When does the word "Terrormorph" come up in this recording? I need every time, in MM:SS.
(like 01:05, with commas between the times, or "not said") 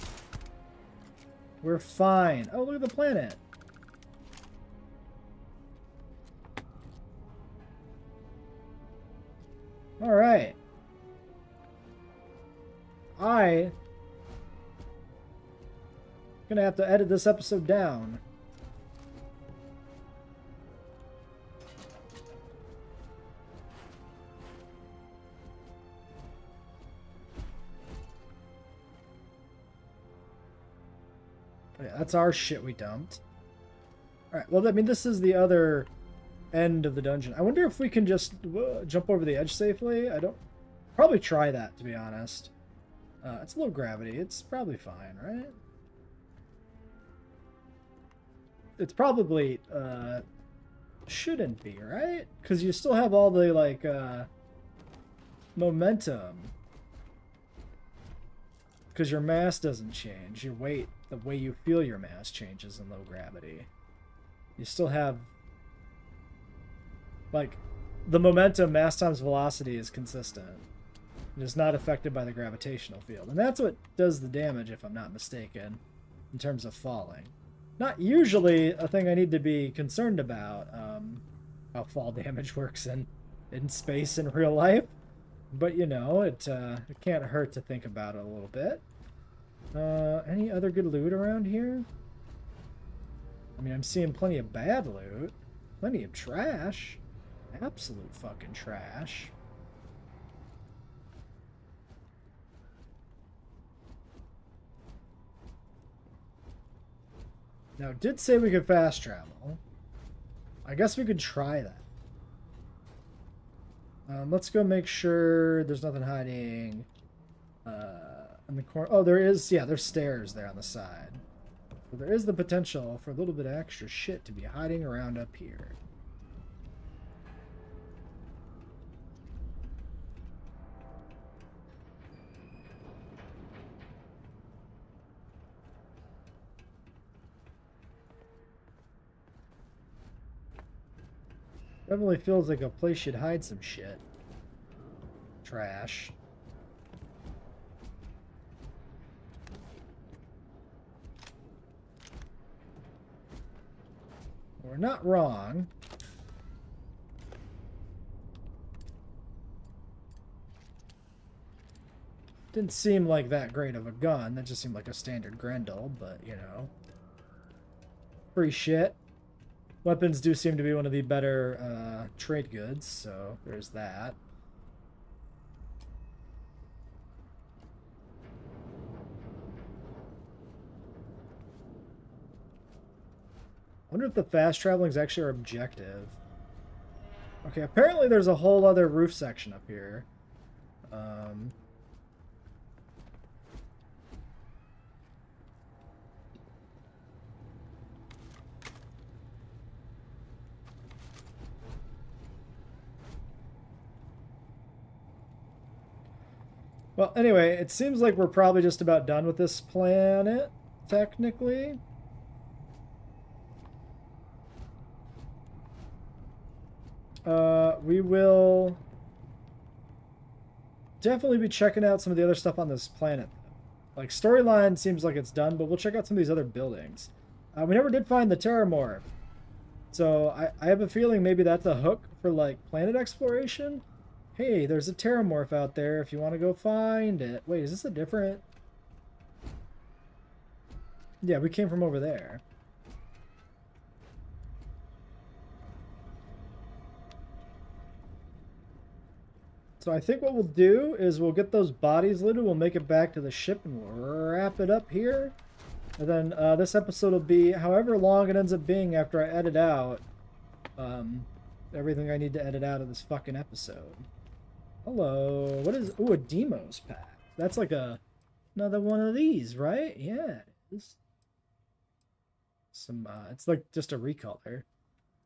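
03:48, 03:54.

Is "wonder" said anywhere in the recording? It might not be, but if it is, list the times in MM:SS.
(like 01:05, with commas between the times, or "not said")
00:37, 03:03.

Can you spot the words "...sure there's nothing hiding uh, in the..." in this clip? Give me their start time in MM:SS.
01:54.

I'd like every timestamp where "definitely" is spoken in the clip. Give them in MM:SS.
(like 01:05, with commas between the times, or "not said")
02:21, 03:40.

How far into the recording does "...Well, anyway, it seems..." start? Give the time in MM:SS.
03:26.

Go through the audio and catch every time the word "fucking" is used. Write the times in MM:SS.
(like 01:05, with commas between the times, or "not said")
01:38, 04:23.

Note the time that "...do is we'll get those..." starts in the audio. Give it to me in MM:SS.
04:10.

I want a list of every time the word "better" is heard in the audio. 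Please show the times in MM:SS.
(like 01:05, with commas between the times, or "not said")
02:51.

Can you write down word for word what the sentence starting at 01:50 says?
I guess we could try that.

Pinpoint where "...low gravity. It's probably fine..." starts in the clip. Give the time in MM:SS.
00:43.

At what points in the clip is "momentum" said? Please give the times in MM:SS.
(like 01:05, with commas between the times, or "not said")
00:55, 01:08.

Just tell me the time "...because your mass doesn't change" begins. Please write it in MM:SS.
00:58.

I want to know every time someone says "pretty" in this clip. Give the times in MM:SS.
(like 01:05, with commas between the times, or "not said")
not said.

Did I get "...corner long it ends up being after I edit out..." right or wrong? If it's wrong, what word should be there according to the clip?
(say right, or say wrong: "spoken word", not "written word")
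wrong: "however", not "corner".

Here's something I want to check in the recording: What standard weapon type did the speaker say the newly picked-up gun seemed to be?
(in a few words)
Grendel.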